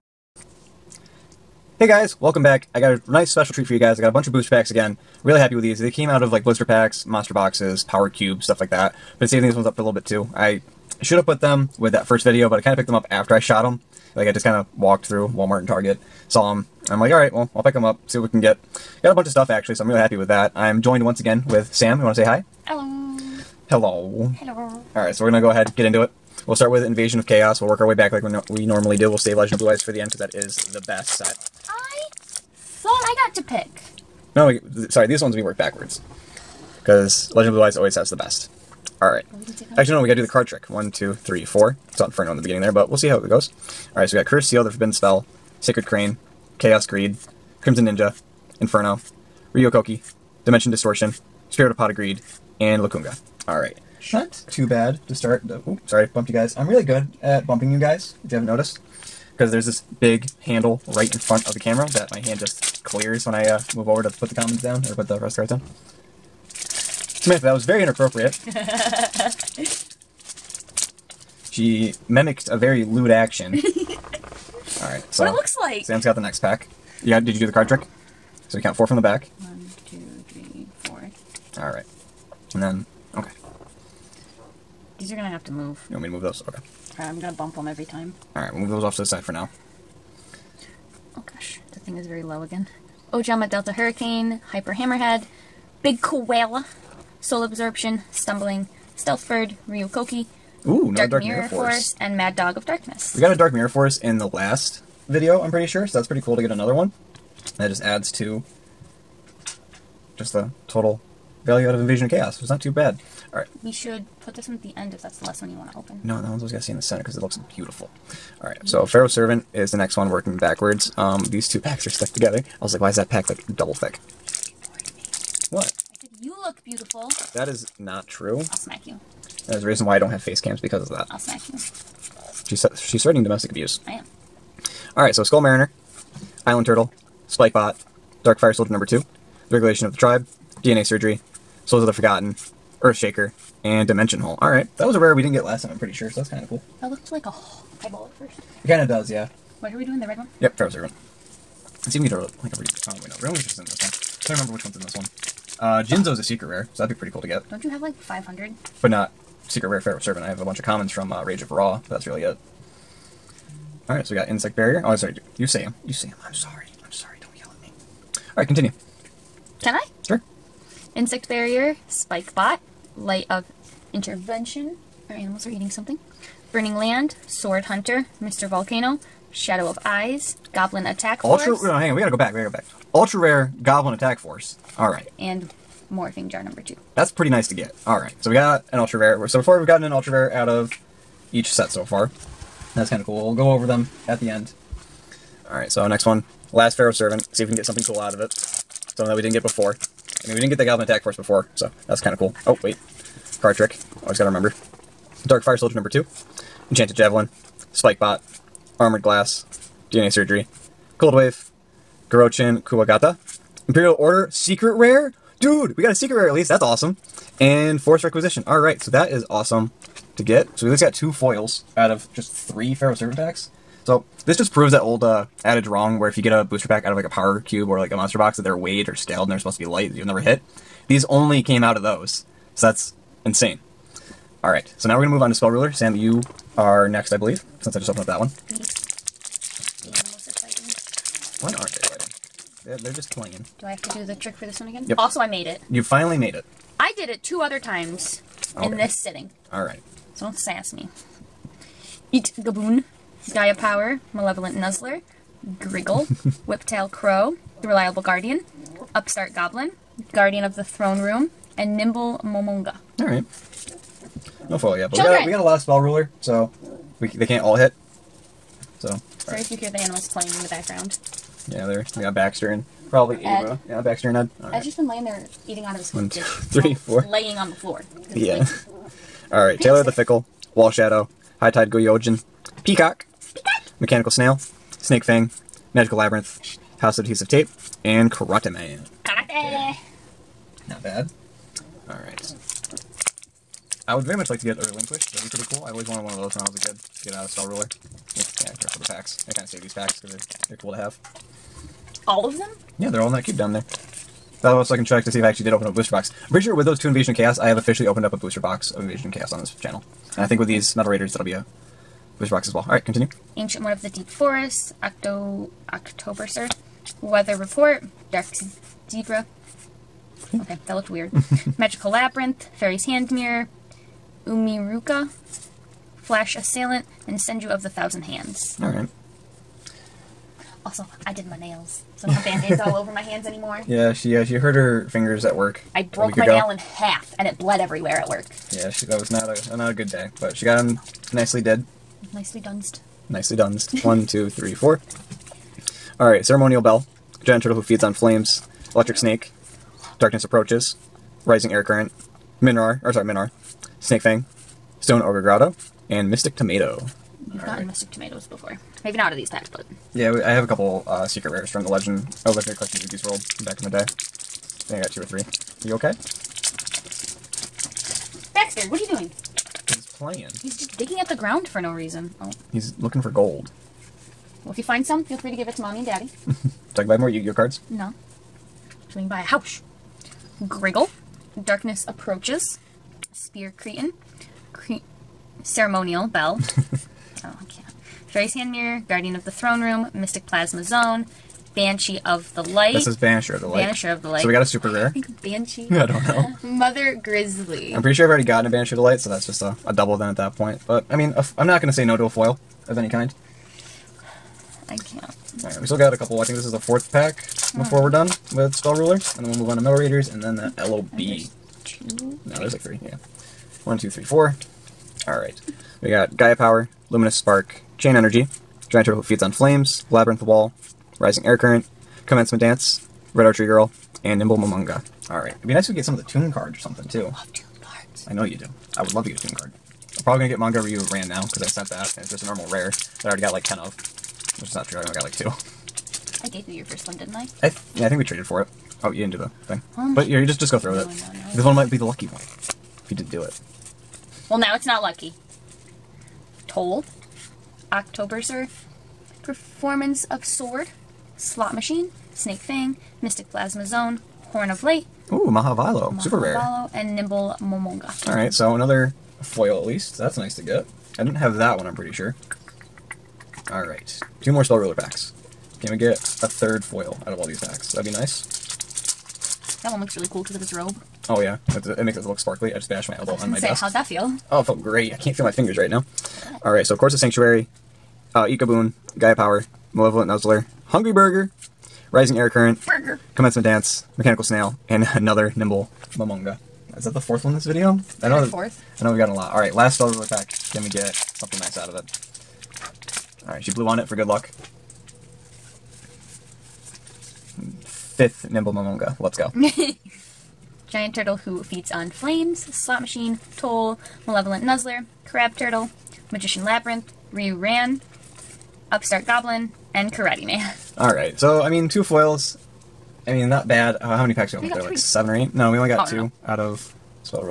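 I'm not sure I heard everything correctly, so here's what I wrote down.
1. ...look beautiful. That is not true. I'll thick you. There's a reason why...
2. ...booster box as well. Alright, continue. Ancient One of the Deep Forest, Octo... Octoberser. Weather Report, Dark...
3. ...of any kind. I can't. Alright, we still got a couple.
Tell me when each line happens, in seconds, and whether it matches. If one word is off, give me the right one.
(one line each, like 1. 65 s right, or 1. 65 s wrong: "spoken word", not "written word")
1. 126 s wrong: "smack", not "thick"
2. 312 s right
3. 402 s right.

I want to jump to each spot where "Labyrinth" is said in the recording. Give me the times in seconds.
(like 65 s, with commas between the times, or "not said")
285 s, 321 s, 419 s, 506 s.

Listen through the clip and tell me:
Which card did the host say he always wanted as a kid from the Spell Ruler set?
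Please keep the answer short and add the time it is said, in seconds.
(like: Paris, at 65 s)
Relinquish, at 294 s.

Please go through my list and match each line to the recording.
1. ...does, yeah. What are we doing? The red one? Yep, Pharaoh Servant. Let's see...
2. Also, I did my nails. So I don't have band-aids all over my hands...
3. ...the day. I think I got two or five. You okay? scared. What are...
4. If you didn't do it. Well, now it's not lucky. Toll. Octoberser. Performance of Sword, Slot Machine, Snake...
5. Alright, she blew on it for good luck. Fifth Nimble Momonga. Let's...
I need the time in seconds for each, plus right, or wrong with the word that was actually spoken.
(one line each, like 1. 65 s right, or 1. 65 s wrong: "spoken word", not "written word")
1. 148 s right
2. 330 s right
3. 363 s wrong: "three", not "five"
4. 442 s right
5. 493 s right.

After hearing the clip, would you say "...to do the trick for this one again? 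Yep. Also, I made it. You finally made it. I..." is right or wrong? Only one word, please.
right.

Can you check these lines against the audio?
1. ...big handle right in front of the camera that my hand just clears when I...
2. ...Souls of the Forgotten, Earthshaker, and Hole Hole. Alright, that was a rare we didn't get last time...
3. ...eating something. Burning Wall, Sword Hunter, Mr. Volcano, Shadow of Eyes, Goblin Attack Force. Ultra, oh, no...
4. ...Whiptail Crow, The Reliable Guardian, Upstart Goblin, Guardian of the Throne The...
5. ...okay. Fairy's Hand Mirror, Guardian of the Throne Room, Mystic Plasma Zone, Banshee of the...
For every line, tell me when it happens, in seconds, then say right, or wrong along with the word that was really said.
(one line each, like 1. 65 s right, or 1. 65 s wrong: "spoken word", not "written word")
1. 59 s right
2. 141 s wrong: "Dimension", not "Hole"
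3. 175 s wrong: "Land", not "Wall"
4. 256 s wrong: "Room", not "The"
5. 387 s right.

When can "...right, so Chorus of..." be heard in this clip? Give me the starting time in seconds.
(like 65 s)
476 s.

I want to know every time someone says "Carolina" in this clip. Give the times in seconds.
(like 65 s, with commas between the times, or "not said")
not said.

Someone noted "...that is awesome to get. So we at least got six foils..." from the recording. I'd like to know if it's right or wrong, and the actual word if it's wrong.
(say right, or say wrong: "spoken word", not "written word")
wrong: "two", not "six".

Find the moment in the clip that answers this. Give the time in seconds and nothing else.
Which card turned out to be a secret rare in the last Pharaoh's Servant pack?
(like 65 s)
213 s.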